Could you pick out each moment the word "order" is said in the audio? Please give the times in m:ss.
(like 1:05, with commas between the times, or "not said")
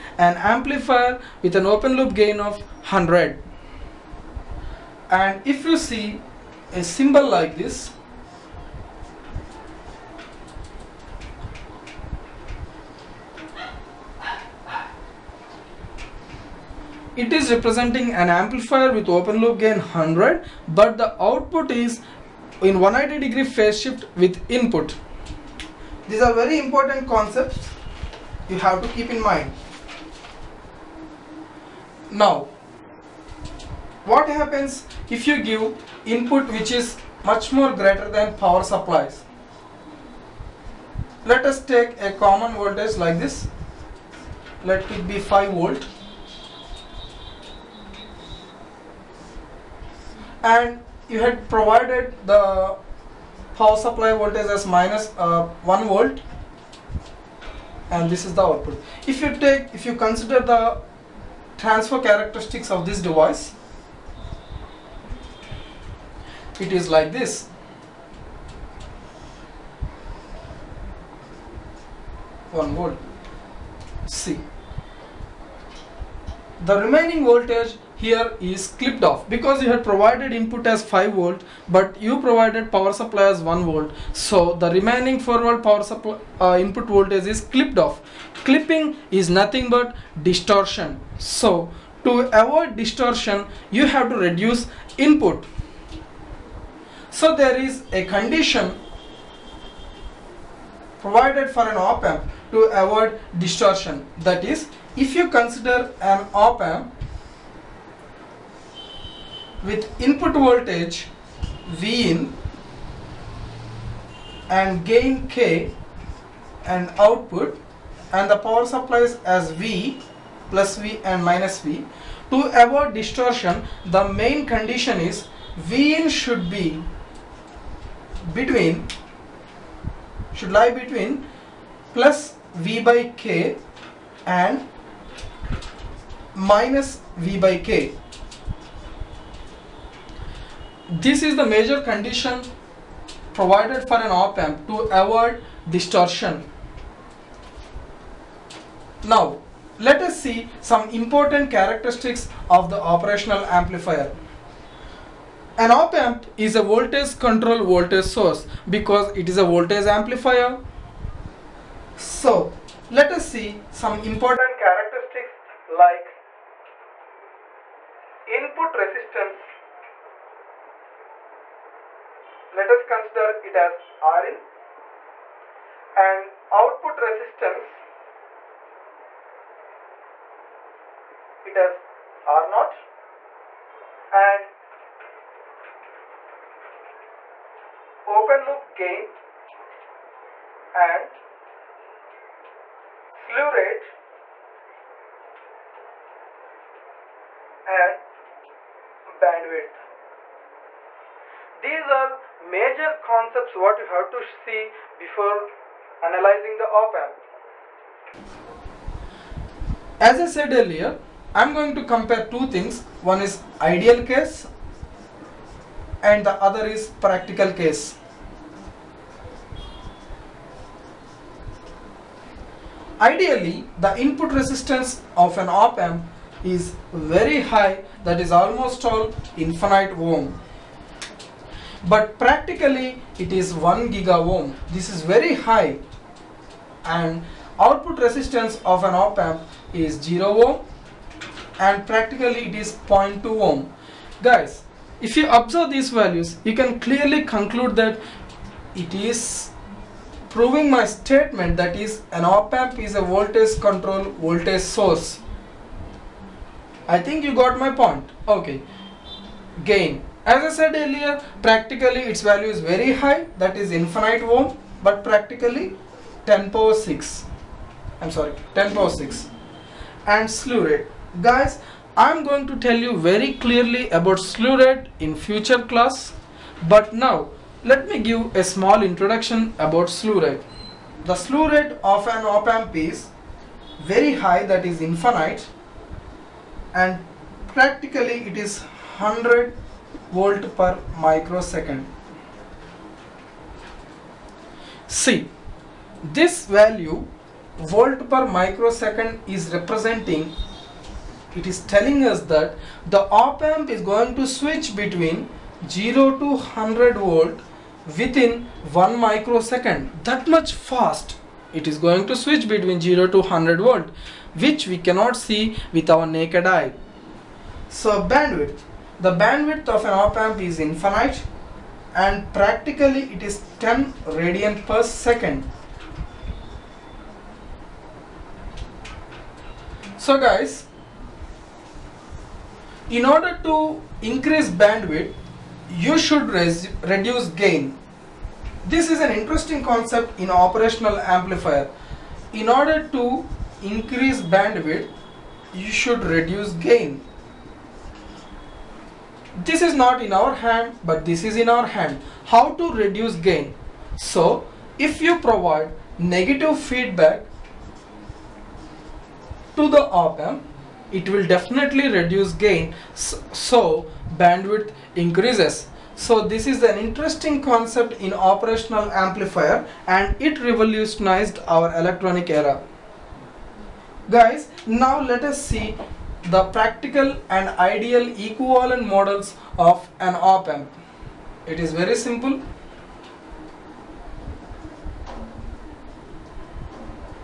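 5:33, 5:42.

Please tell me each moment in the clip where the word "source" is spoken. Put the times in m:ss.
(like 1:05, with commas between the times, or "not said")
2:38, 4:14.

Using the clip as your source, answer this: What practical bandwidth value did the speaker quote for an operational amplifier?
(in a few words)
10 radians per second.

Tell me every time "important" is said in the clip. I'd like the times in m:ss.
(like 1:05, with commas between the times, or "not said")
0:26, 2:30, 2:44.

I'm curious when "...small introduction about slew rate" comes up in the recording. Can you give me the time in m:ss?
4:38.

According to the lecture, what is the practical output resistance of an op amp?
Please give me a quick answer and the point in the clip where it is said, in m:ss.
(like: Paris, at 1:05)
0.2 ohm, at 4:02.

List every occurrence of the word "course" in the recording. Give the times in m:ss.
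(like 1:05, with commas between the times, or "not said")
not said.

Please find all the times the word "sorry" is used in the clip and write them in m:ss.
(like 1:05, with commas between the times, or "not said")
4:28.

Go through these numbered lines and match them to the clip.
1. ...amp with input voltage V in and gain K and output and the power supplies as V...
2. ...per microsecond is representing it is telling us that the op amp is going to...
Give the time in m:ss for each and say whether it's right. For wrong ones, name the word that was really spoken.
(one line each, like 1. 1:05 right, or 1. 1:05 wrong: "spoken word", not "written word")
1. 1:46 right
2. 4:58 right.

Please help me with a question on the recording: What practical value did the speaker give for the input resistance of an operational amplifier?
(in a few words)
1 gigaohm.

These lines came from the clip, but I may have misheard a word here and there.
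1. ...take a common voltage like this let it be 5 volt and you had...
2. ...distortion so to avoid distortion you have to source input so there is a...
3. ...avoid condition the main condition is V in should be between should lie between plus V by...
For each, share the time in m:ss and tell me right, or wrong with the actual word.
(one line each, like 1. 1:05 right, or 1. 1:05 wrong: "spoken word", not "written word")
1. 0:41 right
2. 1:30 wrong: "reduce", not "source"
3. 2:02 wrong: "distortion", not "condition".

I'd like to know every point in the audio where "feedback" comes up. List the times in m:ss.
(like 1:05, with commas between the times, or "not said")
5:56.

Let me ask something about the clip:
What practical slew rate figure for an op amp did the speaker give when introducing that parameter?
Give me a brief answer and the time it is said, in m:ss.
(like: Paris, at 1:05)
100 volts per microsecond, at 4:48.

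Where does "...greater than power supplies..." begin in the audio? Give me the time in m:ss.
0:37.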